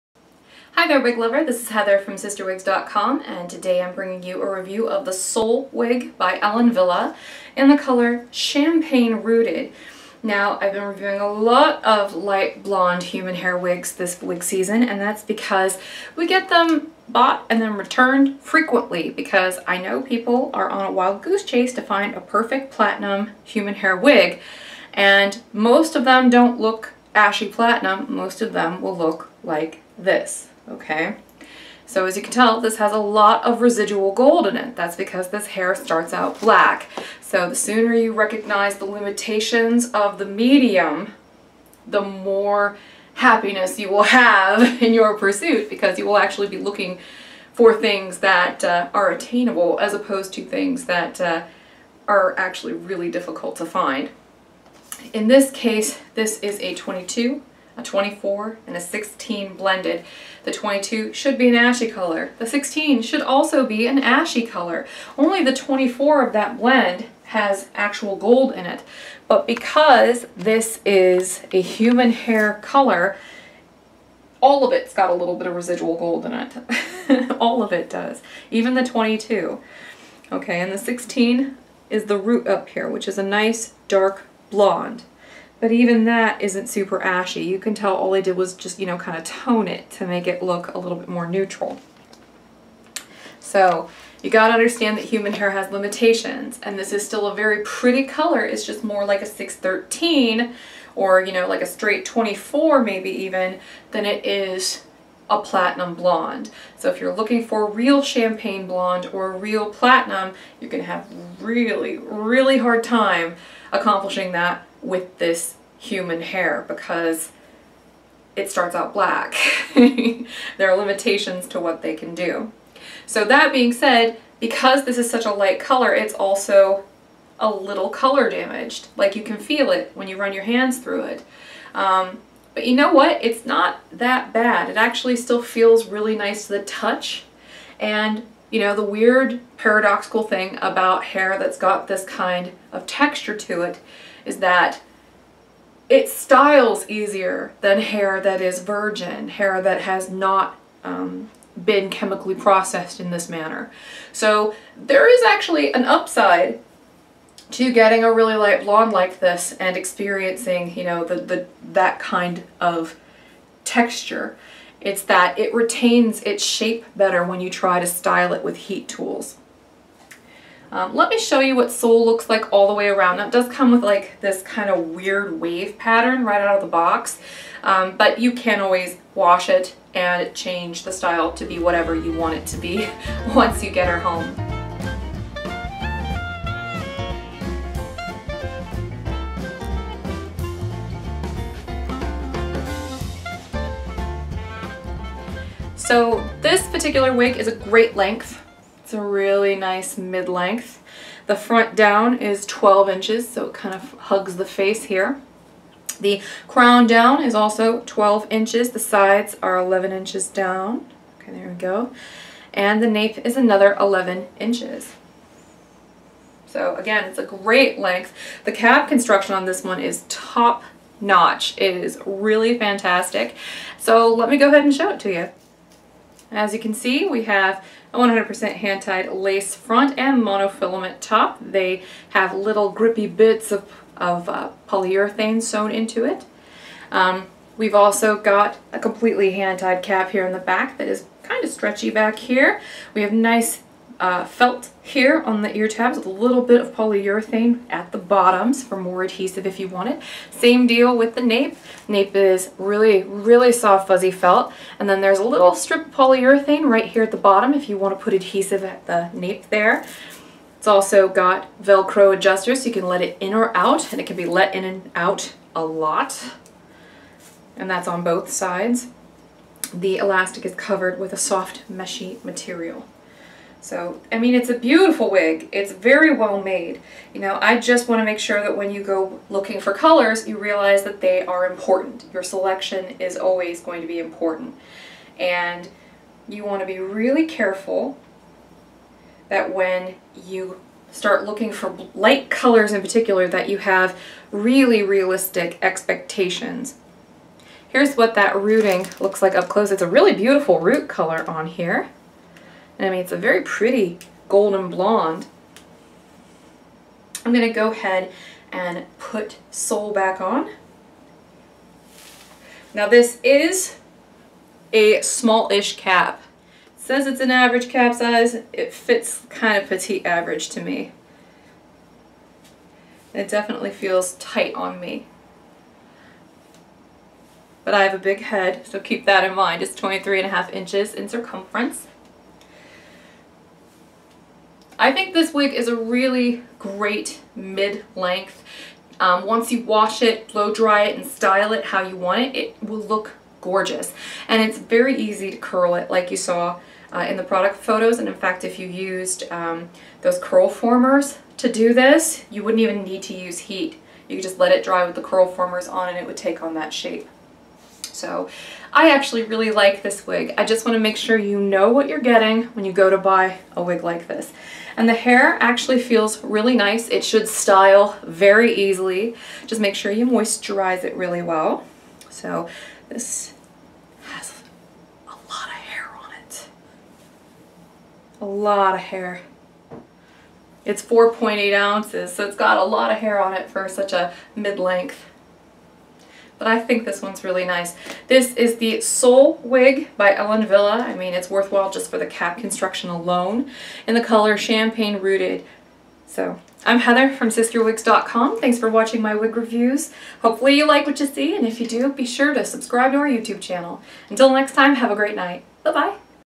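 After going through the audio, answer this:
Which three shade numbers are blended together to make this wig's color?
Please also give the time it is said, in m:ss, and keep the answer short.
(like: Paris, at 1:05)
22, 24, and 16, at 0:56.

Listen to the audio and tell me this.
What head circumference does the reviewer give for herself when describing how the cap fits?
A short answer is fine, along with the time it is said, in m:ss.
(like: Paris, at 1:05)
23.5 inches, at 5:29.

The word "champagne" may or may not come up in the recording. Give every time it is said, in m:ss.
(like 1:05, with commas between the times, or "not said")
0:08, 1:48, 6:34.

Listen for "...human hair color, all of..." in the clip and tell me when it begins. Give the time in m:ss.
1:11.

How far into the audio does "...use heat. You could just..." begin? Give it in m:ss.
5:53.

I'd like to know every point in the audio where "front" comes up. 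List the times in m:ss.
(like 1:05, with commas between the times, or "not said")
3:21, 3:49.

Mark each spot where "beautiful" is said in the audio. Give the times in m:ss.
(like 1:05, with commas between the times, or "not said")
4:34, 5:00.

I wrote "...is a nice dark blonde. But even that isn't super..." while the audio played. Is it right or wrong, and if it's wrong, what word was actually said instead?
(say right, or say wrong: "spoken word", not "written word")
right.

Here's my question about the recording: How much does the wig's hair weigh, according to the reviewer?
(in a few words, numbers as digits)
4.8 ounces.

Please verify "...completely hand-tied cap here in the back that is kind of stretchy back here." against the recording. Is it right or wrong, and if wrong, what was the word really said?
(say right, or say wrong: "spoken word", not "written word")
right.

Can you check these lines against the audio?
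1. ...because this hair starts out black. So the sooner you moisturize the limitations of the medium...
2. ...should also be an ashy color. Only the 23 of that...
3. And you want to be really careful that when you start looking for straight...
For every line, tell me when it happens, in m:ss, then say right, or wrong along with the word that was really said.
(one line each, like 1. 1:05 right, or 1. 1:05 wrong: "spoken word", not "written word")
1. 0:34 wrong: "recognize", not "moisturize"
2. 1:03 wrong: "24", not "23"
3. 4:45 wrong: "light", not "straight".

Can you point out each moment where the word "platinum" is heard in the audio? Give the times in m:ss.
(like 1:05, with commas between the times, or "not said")
0:22, 0:27, 1:45, 1:49.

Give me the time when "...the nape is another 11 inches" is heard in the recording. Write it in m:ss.
3:32.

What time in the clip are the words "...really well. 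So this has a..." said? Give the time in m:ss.
6:10.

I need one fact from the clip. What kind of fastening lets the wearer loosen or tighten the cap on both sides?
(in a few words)
Velcro adjusters.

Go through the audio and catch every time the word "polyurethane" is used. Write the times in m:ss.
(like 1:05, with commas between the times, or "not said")
3:54, 4:06, 4:15.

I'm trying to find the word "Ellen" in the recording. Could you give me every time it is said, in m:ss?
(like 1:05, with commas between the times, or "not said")
0:06, 6:30.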